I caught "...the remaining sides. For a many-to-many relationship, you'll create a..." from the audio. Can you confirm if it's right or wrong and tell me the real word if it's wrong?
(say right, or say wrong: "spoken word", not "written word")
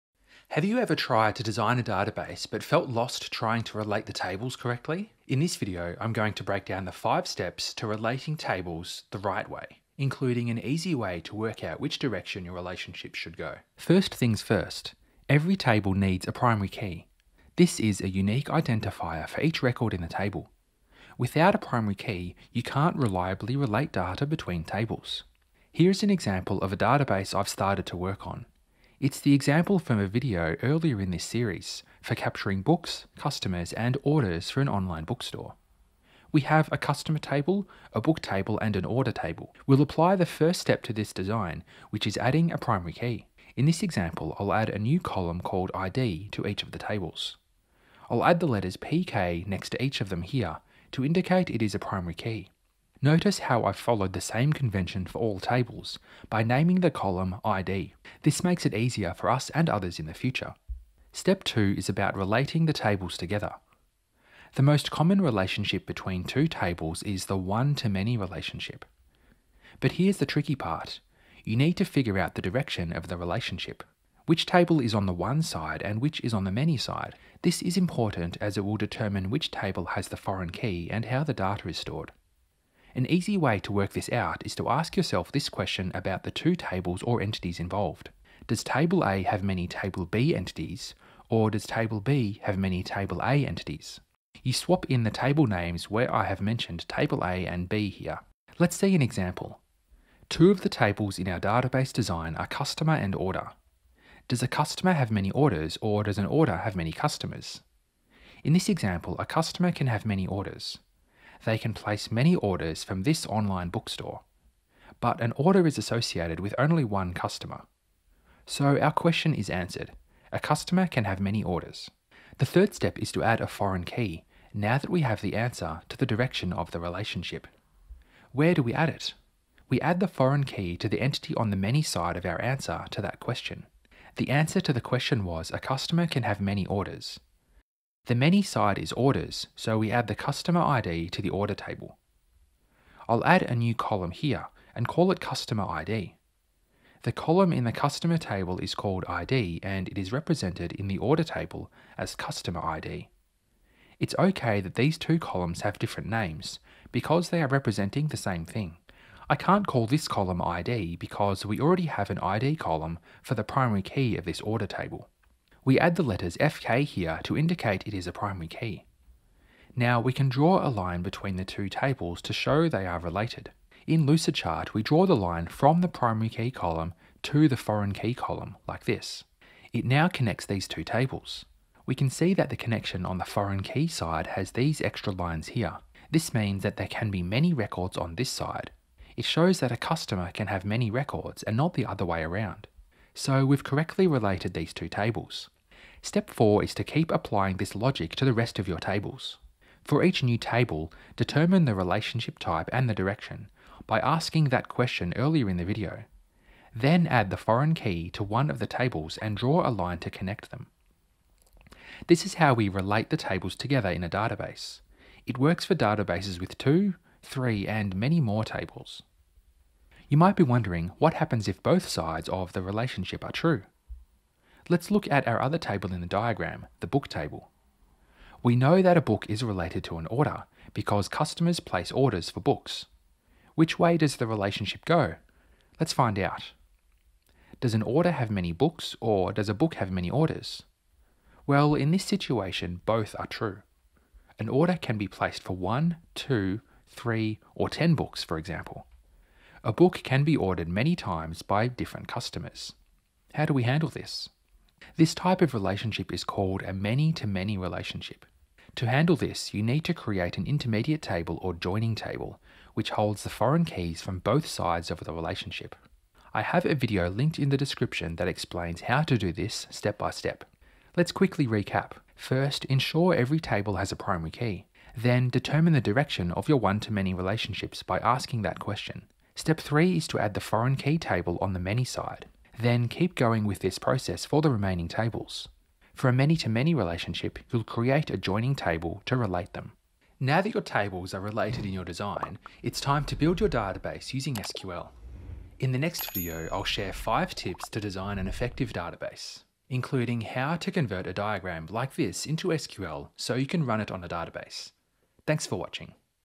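wrong: "tables", not "sides".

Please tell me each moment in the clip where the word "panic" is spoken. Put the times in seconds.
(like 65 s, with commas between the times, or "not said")
not said.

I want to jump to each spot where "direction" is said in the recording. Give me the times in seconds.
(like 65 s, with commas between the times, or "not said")
11 s, 72 s, 126 s, 202 s, 275 s.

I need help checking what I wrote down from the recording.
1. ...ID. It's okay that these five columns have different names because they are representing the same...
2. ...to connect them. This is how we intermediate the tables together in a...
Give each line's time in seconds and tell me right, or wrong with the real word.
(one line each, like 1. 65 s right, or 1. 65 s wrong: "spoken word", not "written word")
1. 152 s wrong: "two", not "five"
2. 209 s wrong: "relate", not "intermediate".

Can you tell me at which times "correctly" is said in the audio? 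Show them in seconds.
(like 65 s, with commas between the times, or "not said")
4 s, 193 s.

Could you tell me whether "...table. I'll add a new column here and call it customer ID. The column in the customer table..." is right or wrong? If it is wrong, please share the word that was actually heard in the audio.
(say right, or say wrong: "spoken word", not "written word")
right.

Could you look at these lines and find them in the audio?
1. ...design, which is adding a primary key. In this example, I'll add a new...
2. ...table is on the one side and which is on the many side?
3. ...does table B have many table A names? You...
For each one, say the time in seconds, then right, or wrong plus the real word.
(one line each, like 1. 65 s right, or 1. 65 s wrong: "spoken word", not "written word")
1. 41 s right
2. 74 s right
3. 91 s wrong: "entities", not "names".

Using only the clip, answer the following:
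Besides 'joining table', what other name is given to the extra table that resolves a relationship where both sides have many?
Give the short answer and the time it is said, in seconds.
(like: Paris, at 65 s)
Intermediate table, at 260 s.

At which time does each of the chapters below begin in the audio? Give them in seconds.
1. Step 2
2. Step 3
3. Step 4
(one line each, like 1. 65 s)
1. 61 s
2. 122 s
3. 195 s.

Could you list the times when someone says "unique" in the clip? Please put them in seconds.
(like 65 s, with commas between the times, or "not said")
18 s.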